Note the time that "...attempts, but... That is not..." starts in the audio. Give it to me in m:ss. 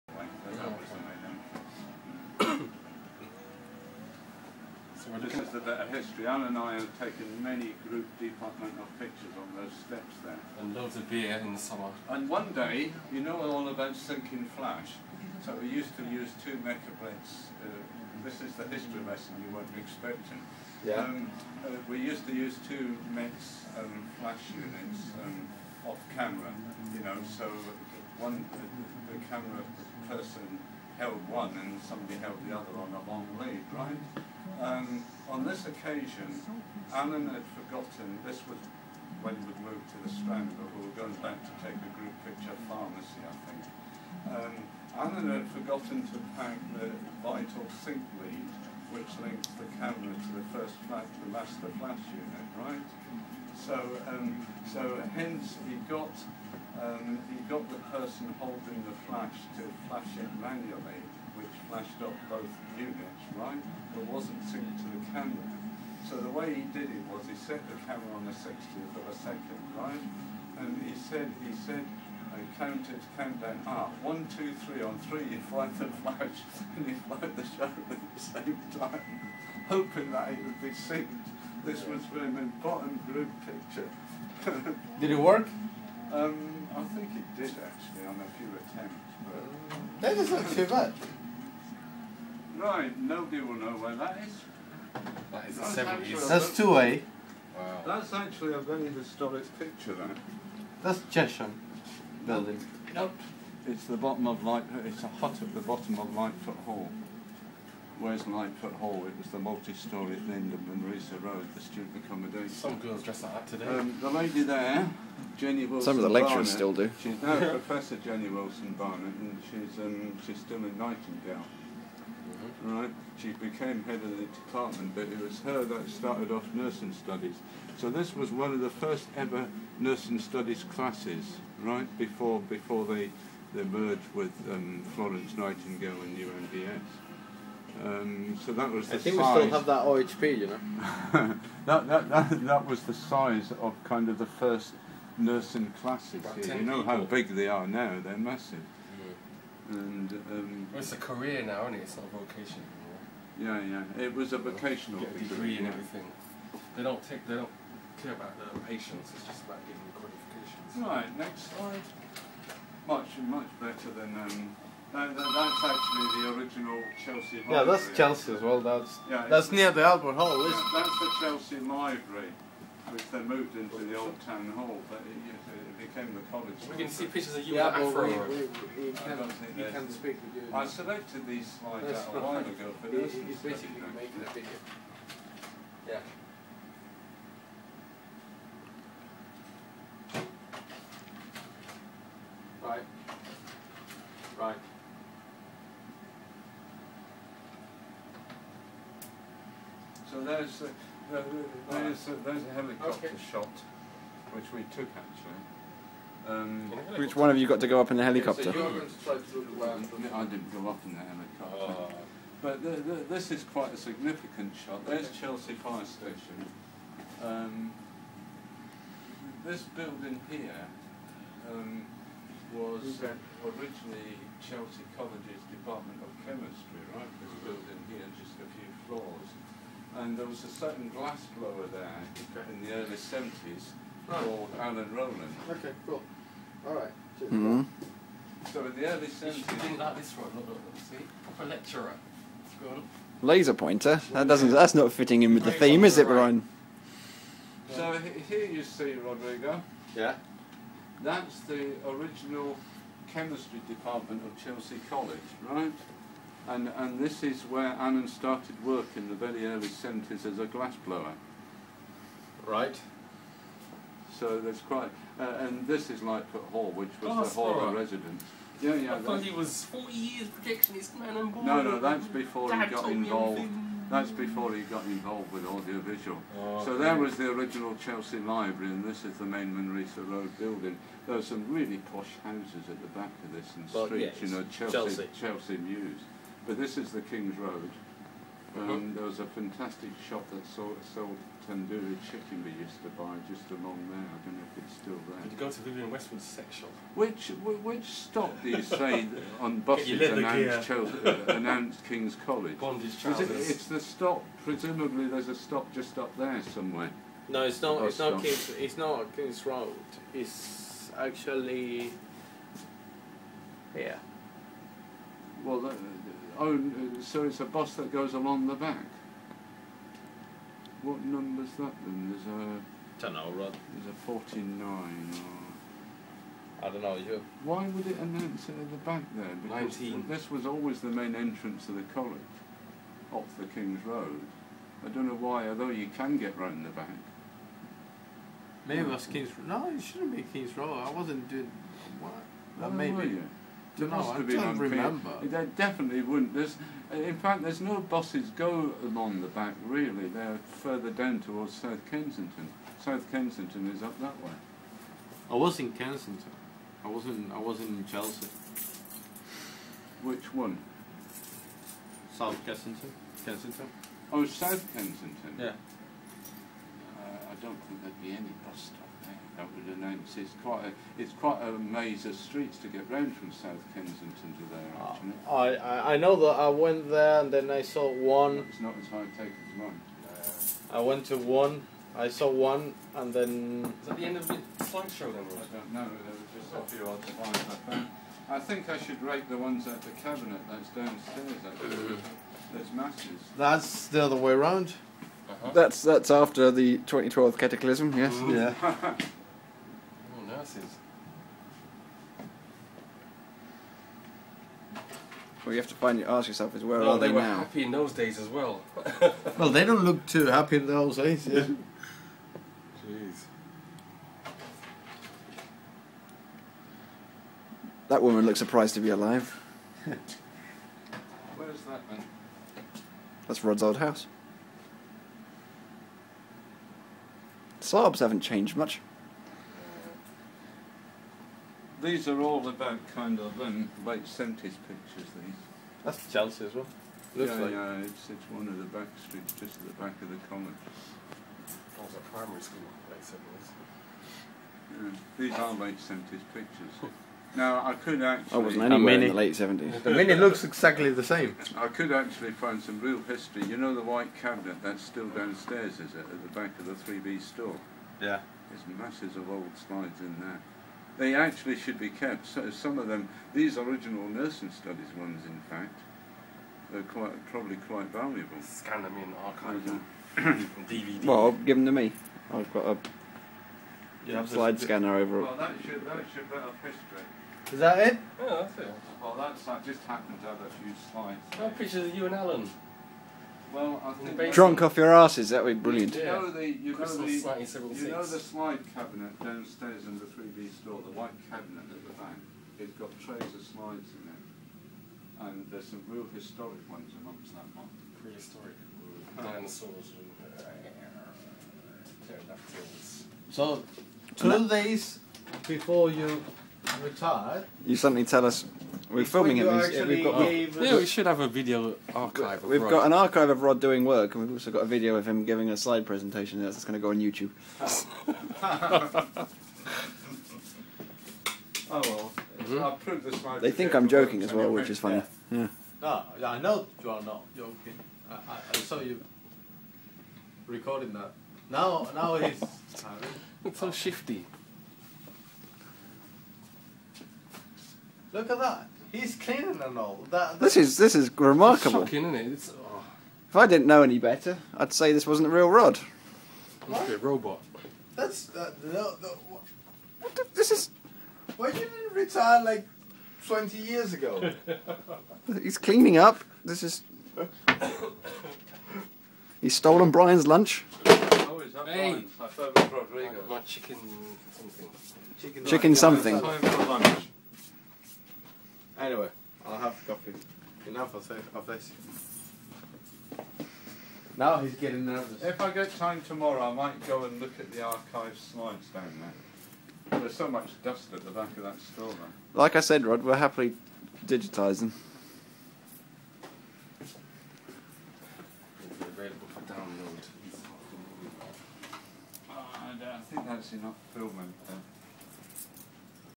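1:28.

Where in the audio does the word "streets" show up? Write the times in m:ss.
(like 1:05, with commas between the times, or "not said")
4:43, 6:12, 7:19.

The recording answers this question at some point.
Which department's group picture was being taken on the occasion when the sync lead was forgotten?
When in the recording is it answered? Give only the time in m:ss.
0:42.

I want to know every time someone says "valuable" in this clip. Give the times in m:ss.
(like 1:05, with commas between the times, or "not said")
7:47.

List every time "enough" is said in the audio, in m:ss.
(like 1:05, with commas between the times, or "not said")
9:30, 9:53.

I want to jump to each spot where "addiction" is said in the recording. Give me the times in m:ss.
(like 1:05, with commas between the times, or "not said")
not said.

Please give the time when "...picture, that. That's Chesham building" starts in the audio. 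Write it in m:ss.
1:39.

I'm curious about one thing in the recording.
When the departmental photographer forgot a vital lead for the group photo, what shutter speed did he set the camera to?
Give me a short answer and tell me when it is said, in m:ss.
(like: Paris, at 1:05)
1/60 second, at 1:08.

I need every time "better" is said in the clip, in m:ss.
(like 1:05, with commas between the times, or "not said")
2:43, 9:03.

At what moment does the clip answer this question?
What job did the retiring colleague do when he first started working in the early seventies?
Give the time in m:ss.
3:50.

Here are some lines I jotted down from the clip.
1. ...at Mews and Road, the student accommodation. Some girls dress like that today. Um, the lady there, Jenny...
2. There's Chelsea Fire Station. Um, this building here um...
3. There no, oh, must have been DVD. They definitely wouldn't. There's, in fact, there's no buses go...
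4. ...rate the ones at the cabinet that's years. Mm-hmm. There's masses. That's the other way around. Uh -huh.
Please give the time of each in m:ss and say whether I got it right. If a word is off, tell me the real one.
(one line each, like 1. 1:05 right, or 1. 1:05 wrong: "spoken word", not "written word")
1. 1:50 wrong: "Lindham", not "Mews"
2. 3:34 right
3. 5:43 wrong: "Remember", not "DVD"
4. 6:29 wrong: "downstairs", not "years".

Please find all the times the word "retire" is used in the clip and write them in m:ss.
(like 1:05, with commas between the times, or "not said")
8:26, 9:11.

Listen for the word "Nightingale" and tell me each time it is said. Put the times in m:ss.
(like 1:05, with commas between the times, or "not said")
2:00, 2:15.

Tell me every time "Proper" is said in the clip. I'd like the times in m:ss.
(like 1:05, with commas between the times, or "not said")
4:01.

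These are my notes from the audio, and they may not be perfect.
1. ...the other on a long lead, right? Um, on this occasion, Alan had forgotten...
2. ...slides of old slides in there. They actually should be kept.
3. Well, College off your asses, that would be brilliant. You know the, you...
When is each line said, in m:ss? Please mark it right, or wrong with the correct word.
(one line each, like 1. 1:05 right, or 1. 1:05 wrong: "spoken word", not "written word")
1. 0:32 right
2. 7:38 wrong: "masses", not "slides"
3. 8:03 wrong: "Drunk", not "College".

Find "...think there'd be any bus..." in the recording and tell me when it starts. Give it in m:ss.
6:07.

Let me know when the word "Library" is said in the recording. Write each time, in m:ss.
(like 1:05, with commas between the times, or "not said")
2:47, 2:51, 4:38.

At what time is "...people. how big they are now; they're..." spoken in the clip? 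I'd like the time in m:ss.
2:26.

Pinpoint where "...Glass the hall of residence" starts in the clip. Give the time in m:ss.
4:27.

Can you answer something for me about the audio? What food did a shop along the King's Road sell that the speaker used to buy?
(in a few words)
Tandoori chicken.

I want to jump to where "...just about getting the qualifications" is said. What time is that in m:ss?
2:39.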